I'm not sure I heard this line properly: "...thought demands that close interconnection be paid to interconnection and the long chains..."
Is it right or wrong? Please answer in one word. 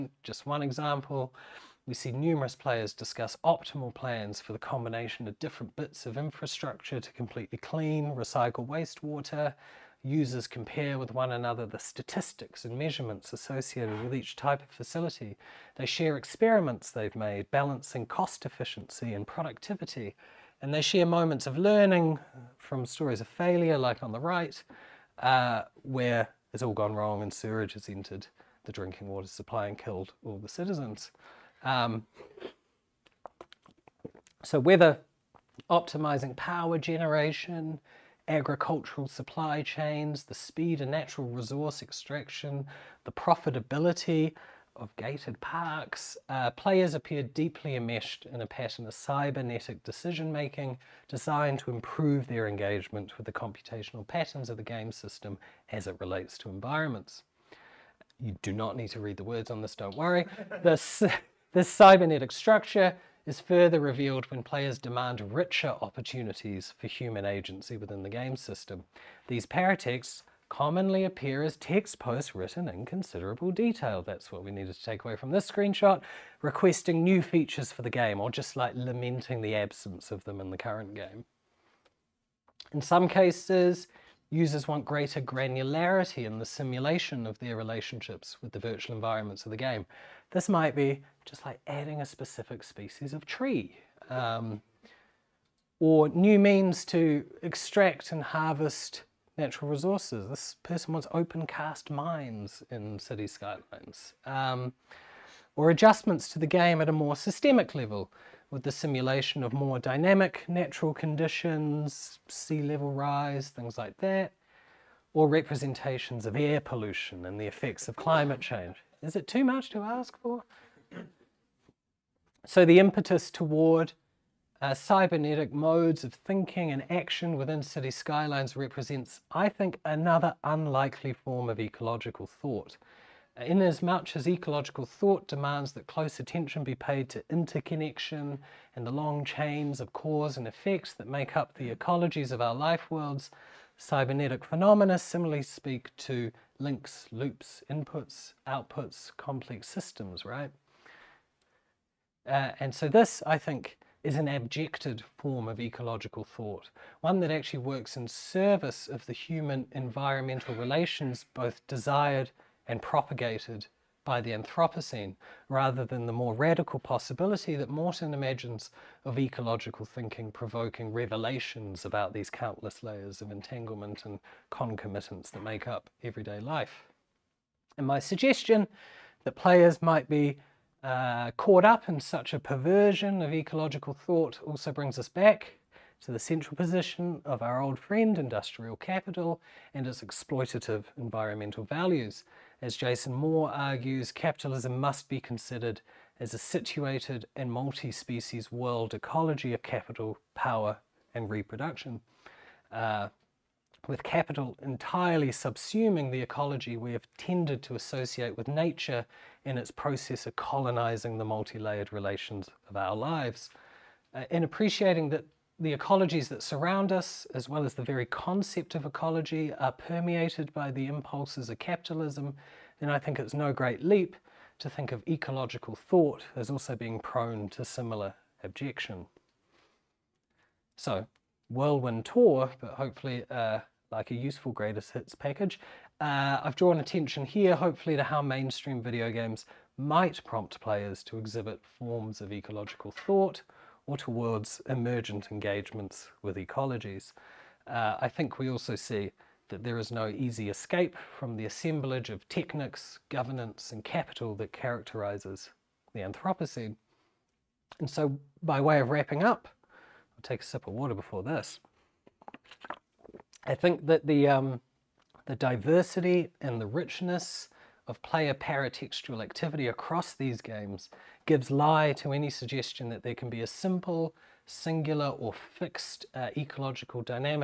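wrong.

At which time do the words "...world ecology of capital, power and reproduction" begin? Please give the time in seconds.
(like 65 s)
198 s.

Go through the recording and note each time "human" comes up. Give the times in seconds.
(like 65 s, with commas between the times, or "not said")
66 s, 159 s.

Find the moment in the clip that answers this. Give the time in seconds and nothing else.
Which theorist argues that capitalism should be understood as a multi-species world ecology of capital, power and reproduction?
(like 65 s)
192 s.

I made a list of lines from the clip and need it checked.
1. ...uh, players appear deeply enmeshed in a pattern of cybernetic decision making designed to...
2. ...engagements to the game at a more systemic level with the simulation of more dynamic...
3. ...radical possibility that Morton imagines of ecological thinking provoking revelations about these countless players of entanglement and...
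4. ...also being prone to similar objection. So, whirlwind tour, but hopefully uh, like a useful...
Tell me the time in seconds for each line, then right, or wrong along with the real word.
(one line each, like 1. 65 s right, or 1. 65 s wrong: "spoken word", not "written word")
1. 46 s right
2. 105 s wrong: "adjustments", not "engagements"
3. 166 s wrong: "layers", not "players"
4. 226 s right.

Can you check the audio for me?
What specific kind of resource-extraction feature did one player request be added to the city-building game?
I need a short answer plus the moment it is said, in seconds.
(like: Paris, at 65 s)
Open cast mines, at 101 s.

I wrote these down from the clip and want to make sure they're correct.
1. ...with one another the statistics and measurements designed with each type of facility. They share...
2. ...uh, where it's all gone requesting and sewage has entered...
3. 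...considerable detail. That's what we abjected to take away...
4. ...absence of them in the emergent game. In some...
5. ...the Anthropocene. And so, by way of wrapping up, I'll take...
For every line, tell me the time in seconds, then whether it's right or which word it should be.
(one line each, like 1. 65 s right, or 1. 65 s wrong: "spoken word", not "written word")
1. 10 s wrong: "associated", not "designed"
2. 25 s wrong: "wrong", not "requesting"
3. 72 s wrong: "needed", not "abjected"
4. 79 s wrong: "current", not "emergent"
5. 255 s right.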